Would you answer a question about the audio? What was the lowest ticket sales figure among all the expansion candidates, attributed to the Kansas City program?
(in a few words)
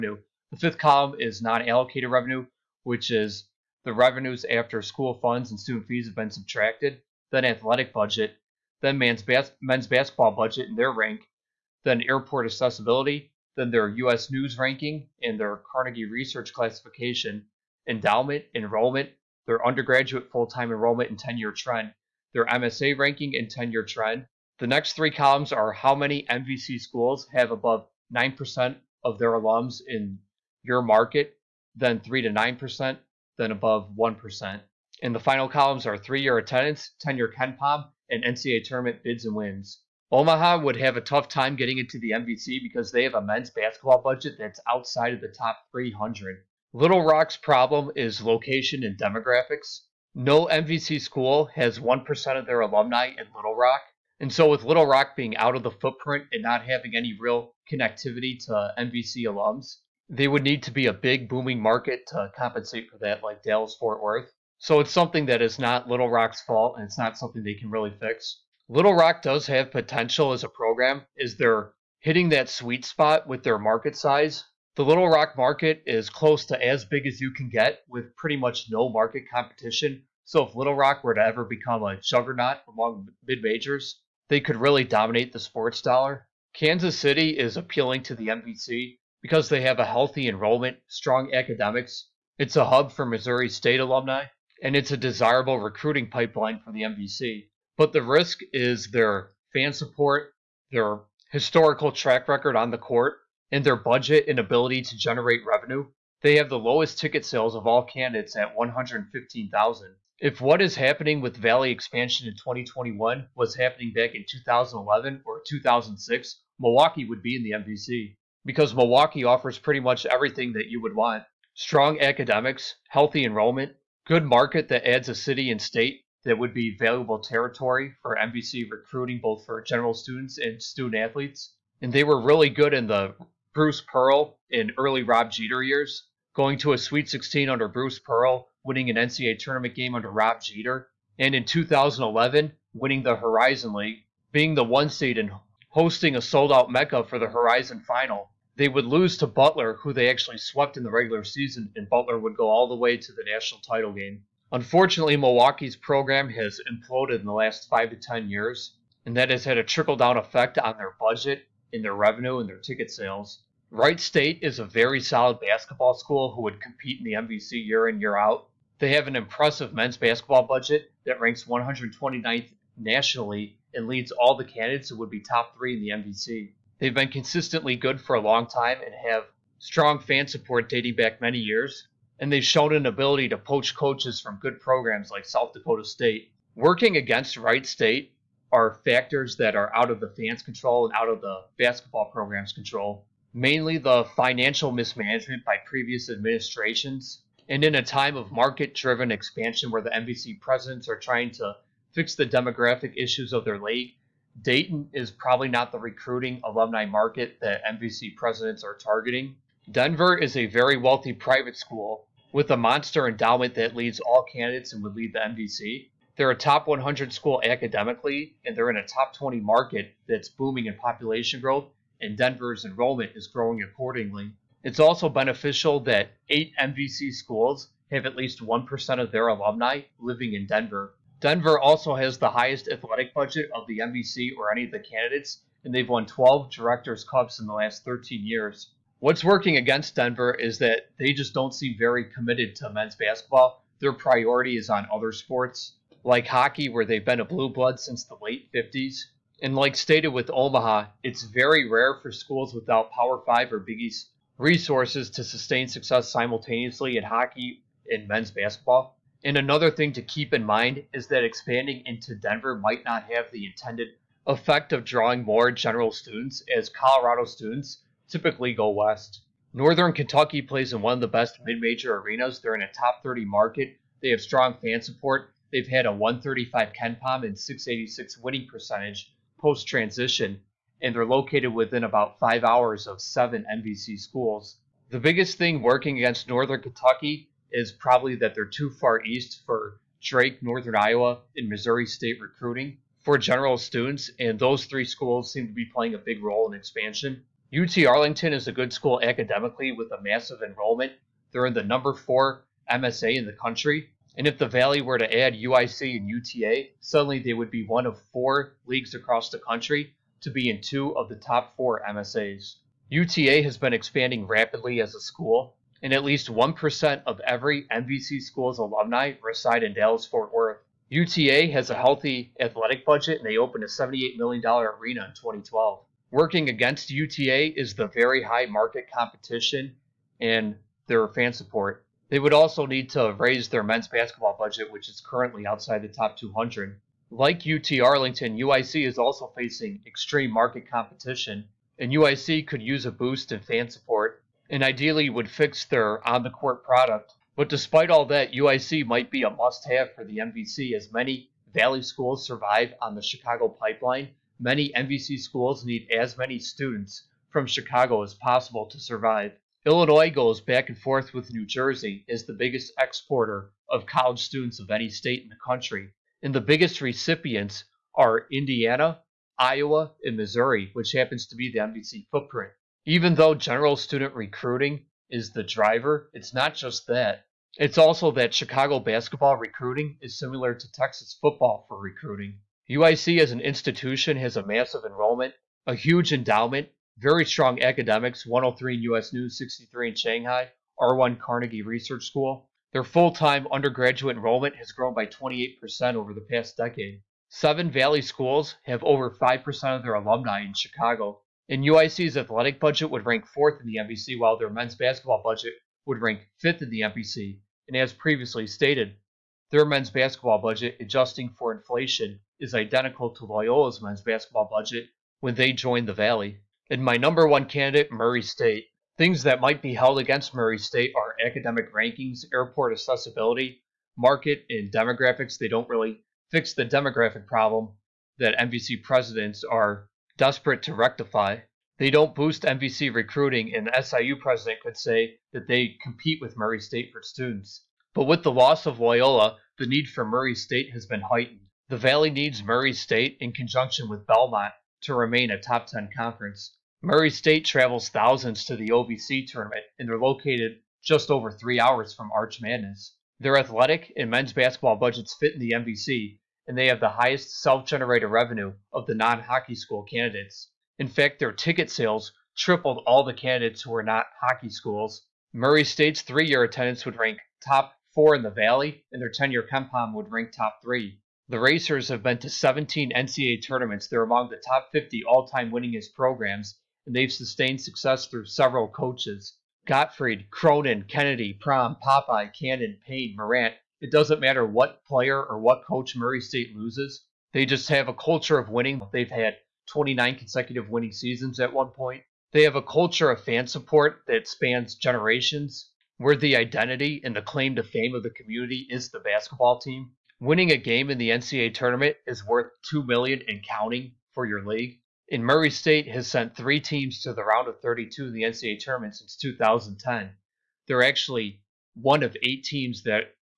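115,000.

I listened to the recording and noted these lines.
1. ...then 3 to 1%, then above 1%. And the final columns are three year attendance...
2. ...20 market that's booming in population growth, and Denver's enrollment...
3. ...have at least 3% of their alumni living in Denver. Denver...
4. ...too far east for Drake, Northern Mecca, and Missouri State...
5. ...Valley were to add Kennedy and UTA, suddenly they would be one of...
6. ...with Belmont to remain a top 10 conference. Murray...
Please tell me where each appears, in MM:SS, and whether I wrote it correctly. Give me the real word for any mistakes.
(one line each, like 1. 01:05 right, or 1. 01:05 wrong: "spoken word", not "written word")
1. 00:31 wrong: "9", not "1"
2. 03:39 right
3. 03:47 wrong: "1", not "3"
4. 04:48 wrong: "Iowa", not "Mecca"
5. 05:04 wrong: "UIC", not "Kennedy"
6. 07:23 right.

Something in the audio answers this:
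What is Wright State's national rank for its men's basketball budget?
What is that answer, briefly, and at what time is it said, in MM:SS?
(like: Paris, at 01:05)
129th, at 02:51.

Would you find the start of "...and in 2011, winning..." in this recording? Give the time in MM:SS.
02:21.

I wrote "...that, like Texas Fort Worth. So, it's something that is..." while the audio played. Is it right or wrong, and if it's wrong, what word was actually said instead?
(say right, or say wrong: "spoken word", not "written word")
wrong: "Dallas", not "Texas".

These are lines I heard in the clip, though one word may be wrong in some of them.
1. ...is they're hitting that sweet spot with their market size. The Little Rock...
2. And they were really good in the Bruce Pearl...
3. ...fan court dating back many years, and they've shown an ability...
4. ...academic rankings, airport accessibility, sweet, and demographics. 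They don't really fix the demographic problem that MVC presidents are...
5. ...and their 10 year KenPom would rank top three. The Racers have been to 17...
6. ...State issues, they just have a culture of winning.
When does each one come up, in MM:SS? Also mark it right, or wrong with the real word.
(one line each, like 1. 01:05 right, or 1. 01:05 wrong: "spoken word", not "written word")
1. 01:11 right
2. 02:11 right
3. 02:59 wrong: "support", not "court"
4. 07:01 wrong: "market", not "sweet"
5. 07:48 right
6. 08:06 wrong: "loses", not "issues".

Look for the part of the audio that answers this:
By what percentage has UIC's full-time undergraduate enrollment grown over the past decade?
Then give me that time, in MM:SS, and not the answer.
06:35.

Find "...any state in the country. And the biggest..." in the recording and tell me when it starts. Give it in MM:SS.
06:04.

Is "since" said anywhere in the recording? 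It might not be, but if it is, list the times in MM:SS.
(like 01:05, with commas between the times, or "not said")
04:07, 08:28.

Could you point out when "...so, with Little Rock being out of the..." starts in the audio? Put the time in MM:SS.
00:54.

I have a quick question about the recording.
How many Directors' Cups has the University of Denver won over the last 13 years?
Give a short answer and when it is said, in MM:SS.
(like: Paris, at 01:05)
12, at 03:56.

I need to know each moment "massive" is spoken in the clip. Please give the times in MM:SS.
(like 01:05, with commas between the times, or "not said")
05:00, 06:24.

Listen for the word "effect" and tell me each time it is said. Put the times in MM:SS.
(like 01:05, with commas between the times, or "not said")
02:40, 04:24.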